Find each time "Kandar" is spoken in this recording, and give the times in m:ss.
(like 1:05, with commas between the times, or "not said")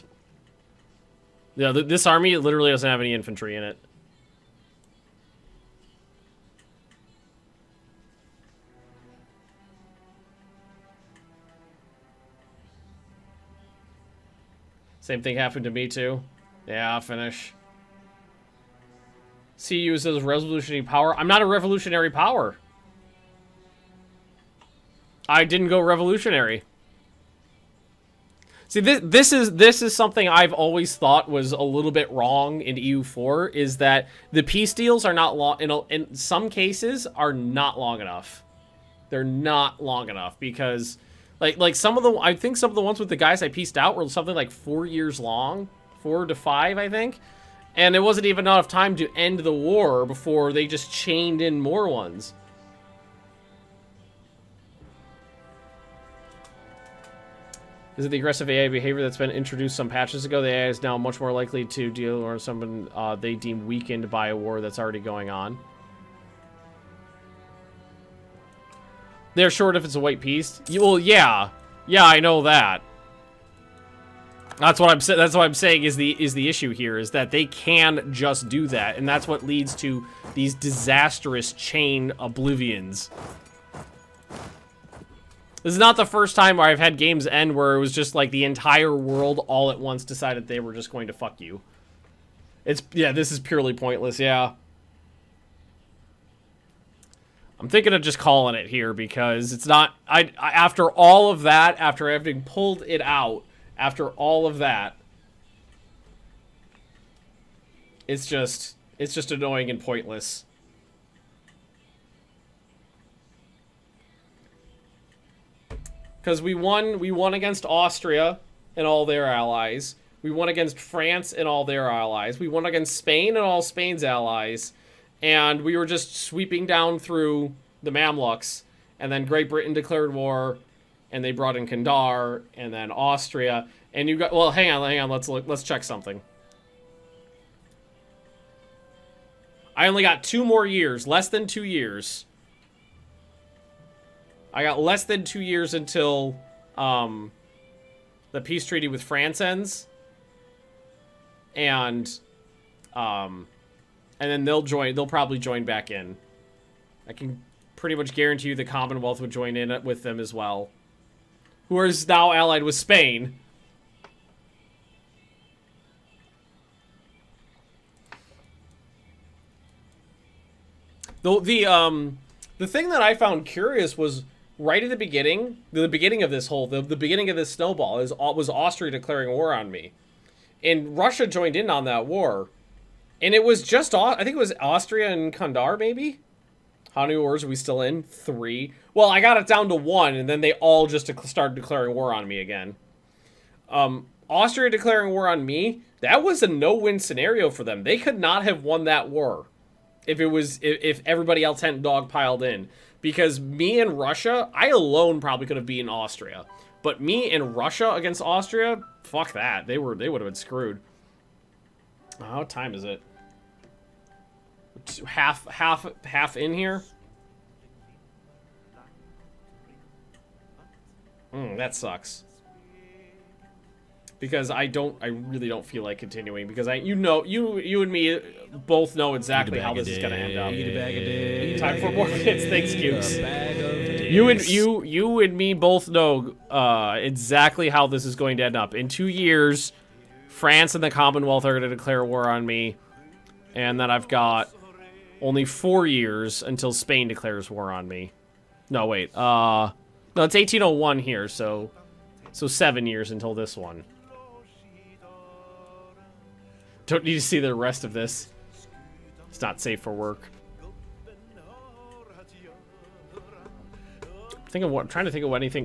2:11, 3:05.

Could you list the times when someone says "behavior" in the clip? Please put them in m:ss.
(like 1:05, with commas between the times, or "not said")
0:58.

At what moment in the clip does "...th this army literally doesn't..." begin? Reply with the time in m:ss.
0:01.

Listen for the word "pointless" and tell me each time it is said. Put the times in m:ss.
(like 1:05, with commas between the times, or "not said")
1:33, 1:49.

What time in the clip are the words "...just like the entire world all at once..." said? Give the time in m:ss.
1:27.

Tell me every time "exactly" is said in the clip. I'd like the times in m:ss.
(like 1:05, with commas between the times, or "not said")
3:49, 3:56.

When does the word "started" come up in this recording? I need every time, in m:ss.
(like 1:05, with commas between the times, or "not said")
3:11.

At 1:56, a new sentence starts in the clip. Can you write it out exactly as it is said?
Because we won, we won against Austria and all their allies.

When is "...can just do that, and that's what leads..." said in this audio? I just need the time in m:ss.
1:17.